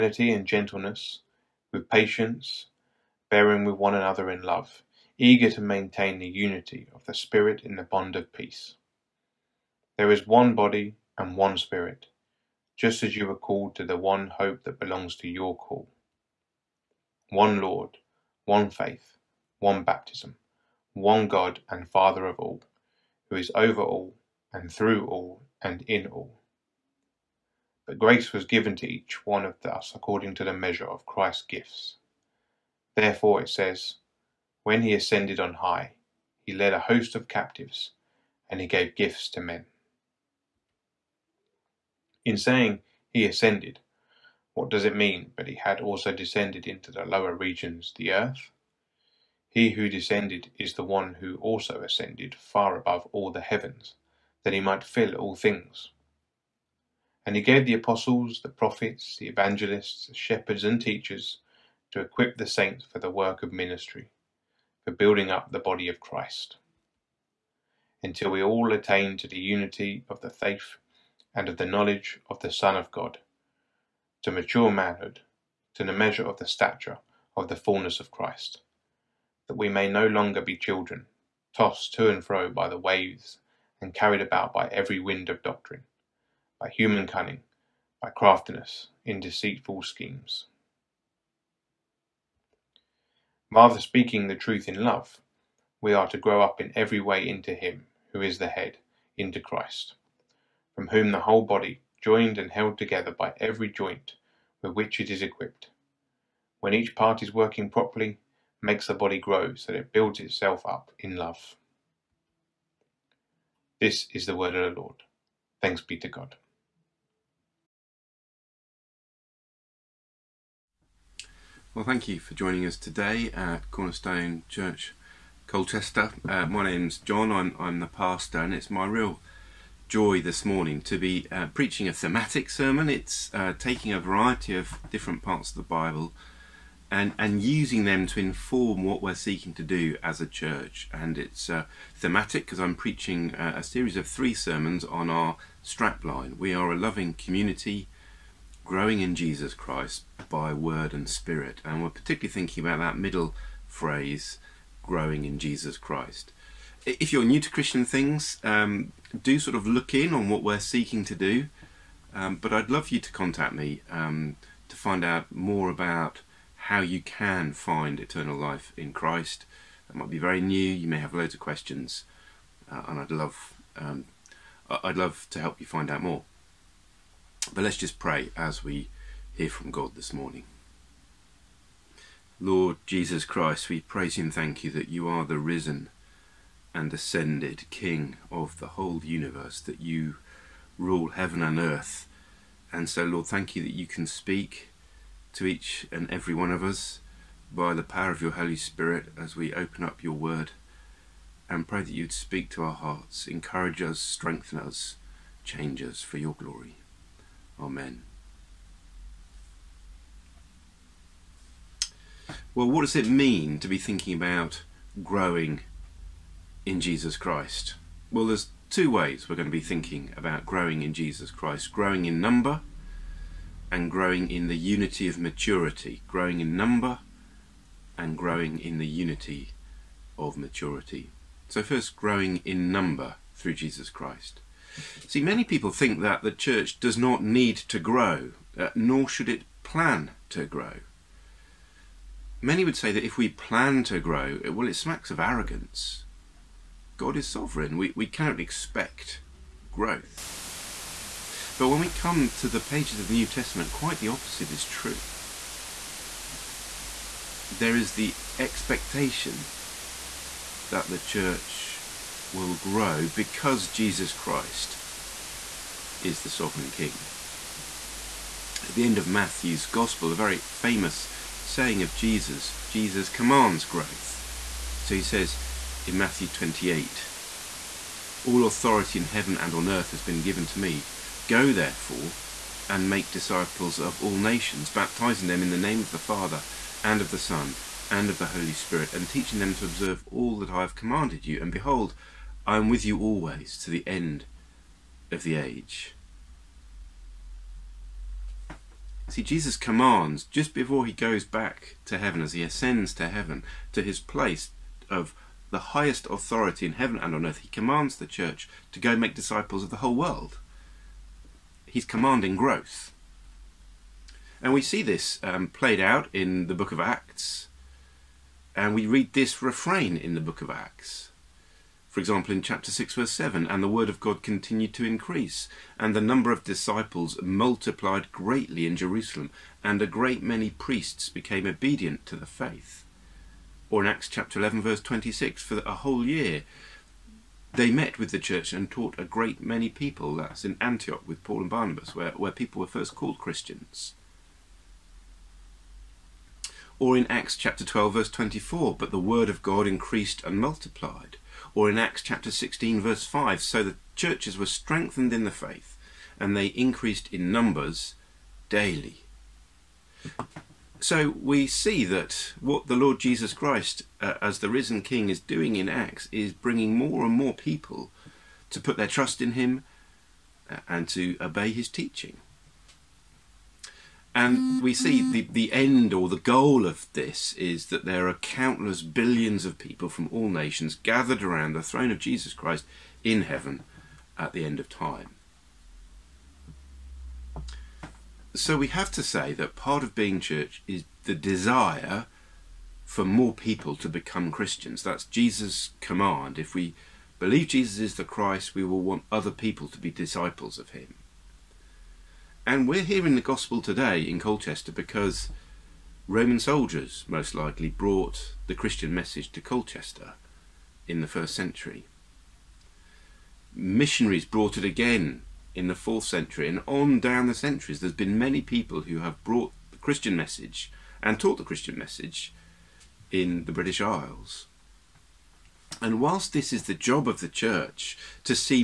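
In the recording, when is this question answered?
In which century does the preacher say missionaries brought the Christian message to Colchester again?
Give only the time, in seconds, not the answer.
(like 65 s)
415 s.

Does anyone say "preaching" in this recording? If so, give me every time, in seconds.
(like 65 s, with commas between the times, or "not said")
131 s, 142 s.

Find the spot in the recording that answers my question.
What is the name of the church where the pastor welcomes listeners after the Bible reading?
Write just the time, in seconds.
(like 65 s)
123 s.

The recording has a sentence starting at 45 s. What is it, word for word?
But he had also descended into the lower regions, the earth.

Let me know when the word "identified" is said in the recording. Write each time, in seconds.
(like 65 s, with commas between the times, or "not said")
not said.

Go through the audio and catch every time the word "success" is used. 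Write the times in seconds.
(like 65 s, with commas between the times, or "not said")
not said.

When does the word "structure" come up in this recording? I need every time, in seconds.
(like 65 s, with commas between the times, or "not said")
not said.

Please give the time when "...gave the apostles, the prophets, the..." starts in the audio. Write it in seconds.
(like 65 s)
57 s.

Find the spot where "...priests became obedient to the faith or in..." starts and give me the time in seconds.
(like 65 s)
330 s.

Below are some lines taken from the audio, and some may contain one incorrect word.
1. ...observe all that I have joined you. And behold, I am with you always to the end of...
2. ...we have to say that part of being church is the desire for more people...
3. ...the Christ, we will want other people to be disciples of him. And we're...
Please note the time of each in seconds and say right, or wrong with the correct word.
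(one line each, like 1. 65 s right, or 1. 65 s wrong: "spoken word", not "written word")
1. 289 s wrong: "commanded", not "joined"
2. 388 s right
3. 397 s right.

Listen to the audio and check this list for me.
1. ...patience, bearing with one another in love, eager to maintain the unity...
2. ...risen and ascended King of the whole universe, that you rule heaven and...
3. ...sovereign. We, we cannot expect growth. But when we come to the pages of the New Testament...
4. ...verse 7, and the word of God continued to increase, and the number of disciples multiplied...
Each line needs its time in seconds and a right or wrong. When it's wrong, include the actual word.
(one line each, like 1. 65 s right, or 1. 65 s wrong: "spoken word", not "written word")
1. 1 s right
2. 185 s right
3. 247 s right
4. 322 s right.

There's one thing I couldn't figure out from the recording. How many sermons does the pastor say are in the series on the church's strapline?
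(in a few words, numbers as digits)
3.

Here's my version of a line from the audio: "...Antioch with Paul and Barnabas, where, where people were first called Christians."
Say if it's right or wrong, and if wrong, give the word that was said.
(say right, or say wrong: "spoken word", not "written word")
right.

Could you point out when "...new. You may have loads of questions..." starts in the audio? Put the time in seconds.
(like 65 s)
170 s.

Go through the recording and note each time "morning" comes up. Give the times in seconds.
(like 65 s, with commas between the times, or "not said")
130 s, 180 s.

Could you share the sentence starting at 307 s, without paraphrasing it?
He commands the church to go make disciples of the whole world.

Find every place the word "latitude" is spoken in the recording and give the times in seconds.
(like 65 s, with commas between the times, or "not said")
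not said.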